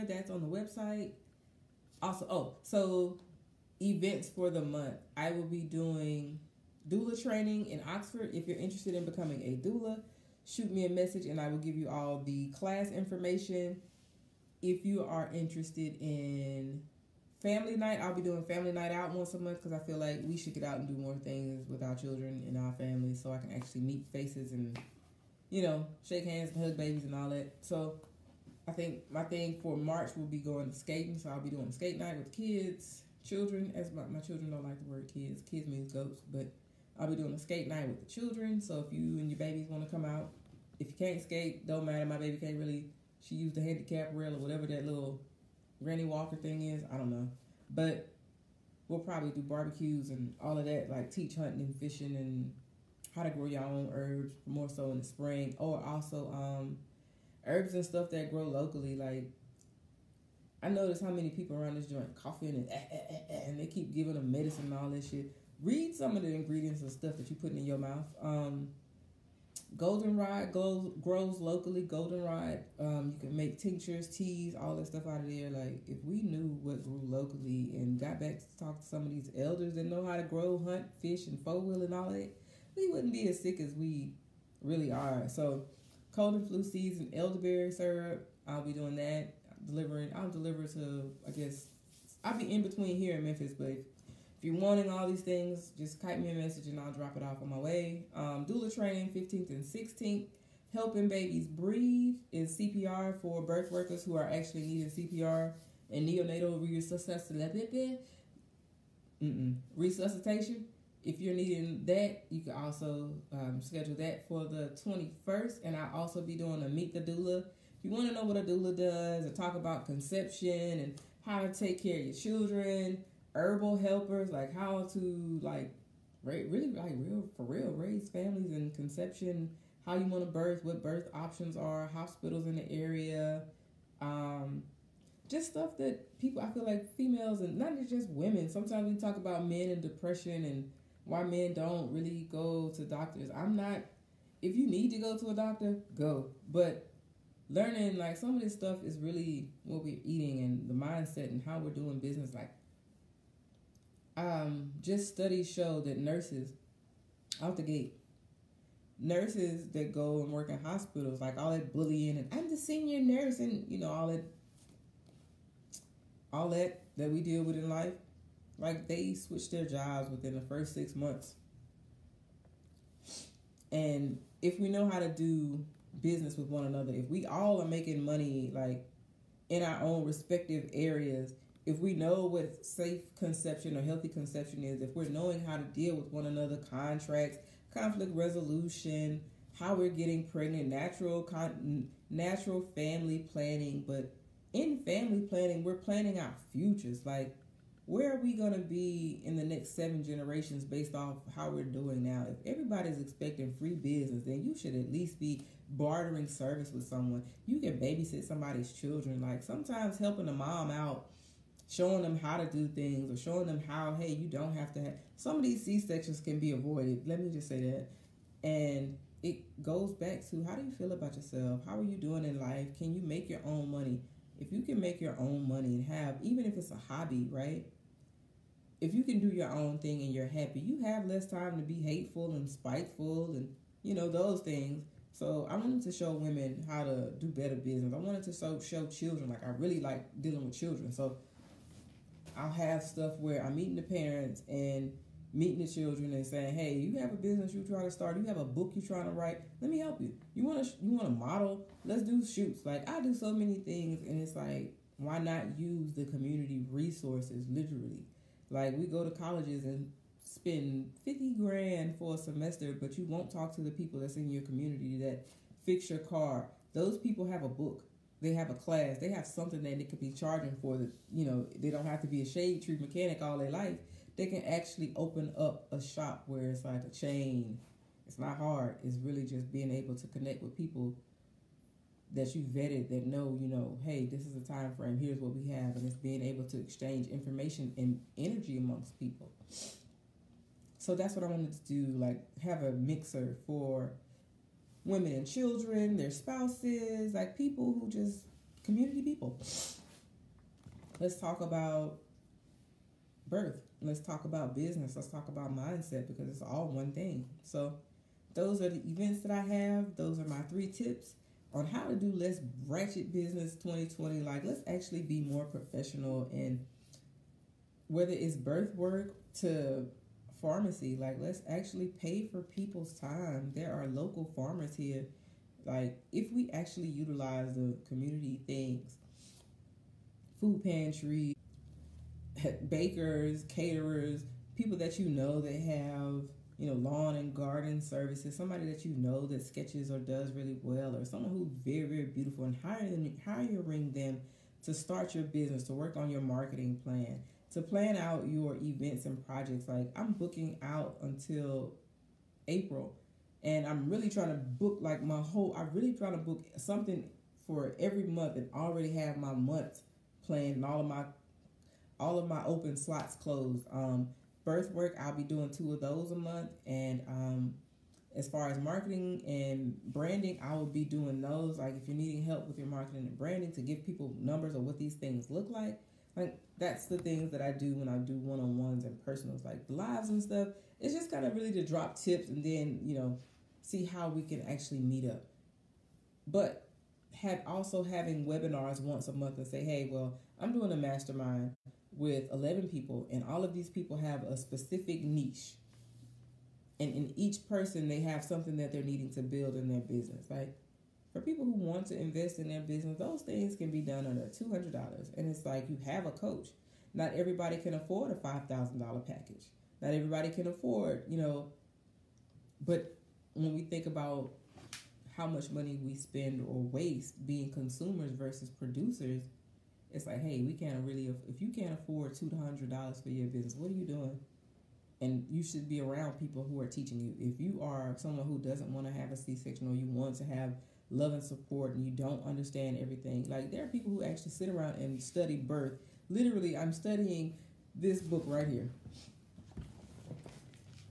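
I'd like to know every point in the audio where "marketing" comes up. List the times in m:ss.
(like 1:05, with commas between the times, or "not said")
5:46, 6:08, 6:12.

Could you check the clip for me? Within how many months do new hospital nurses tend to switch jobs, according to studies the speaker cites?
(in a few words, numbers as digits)
6 months.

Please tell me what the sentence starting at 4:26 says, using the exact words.
Those people have a book they have a class, they have something that they could be charging for.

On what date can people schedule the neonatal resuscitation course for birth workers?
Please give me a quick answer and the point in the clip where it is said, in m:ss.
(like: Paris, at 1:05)
21st, at 1:54.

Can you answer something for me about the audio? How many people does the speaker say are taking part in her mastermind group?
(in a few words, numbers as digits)
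11.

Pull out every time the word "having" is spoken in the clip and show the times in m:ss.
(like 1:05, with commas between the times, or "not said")
6:27.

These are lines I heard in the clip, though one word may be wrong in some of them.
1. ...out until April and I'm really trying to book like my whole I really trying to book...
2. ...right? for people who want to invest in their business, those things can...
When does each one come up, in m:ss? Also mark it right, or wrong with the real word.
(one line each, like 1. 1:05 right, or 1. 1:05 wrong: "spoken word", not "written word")
1. 5:50 right
2. 6:40 right.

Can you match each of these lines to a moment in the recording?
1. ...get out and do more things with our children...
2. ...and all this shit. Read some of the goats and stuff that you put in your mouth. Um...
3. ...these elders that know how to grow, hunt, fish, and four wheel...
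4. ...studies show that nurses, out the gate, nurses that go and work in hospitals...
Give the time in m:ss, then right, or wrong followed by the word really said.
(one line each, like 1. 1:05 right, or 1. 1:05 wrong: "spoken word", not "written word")
1. 0:20 right
2. 1:04 wrong: "ingredients", not "goats"
3. 1:19 right
4. 2:35 right.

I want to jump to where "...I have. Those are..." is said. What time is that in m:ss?
5:09.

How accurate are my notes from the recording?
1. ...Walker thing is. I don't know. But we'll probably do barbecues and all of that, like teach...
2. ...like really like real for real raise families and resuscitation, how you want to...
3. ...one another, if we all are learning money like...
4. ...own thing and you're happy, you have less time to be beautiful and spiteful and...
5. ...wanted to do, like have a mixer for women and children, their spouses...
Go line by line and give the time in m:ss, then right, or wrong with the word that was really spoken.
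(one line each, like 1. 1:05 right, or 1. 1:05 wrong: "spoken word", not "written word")
1. 0:46 right
2. 2:05 wrong: "conception", not "resuscitation"
3. 2:56 wrong: "making", not "learning"
4. 3:49 wrong: "hateful", not "beautiful"
5. 4:51 right.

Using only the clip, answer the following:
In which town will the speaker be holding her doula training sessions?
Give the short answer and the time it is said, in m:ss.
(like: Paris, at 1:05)
Oxford, at 0:07.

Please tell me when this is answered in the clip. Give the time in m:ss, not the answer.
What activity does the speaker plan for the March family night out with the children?
0:30.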